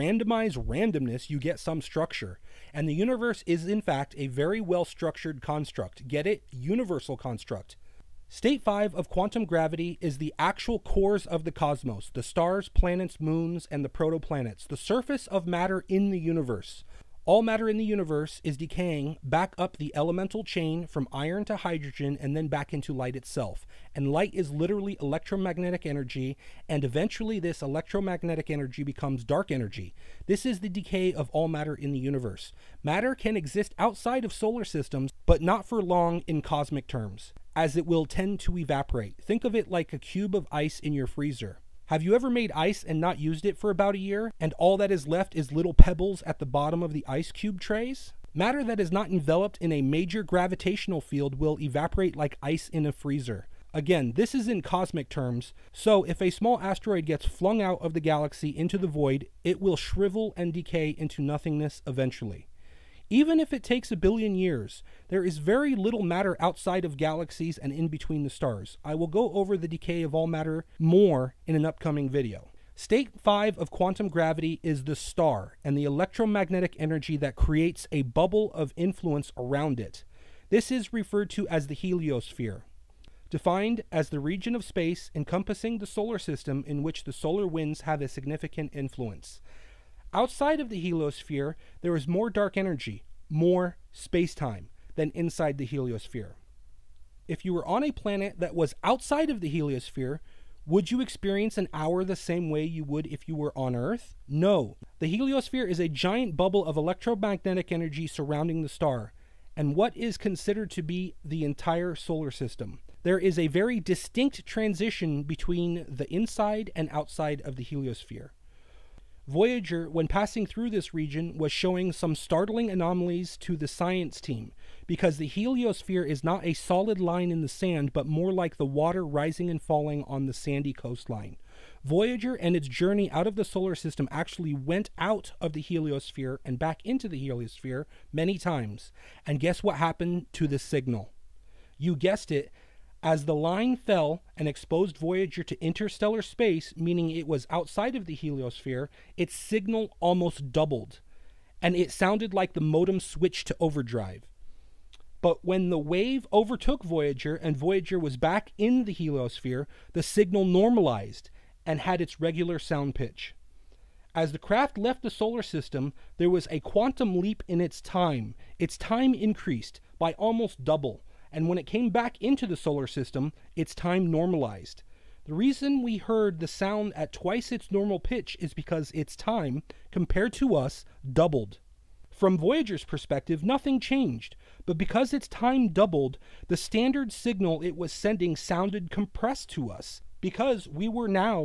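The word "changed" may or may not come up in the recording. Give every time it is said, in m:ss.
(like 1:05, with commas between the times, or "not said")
3:03.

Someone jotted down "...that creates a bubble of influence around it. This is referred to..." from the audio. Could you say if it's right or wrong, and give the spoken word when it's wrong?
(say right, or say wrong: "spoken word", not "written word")
right.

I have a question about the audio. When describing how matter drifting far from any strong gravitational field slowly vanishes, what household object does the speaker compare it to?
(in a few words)
ice in a freezer.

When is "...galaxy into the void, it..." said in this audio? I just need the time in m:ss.
0:57.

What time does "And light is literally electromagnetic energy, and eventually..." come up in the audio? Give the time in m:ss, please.
0:23.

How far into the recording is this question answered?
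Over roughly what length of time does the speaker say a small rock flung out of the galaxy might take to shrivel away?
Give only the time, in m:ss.
1:03.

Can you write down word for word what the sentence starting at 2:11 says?
Voyager and its journey out of the solar system actually went out of the heliosphere and back into the heliosphere many times.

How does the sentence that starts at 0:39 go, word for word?
Think of it like a cube of ice in your freezer.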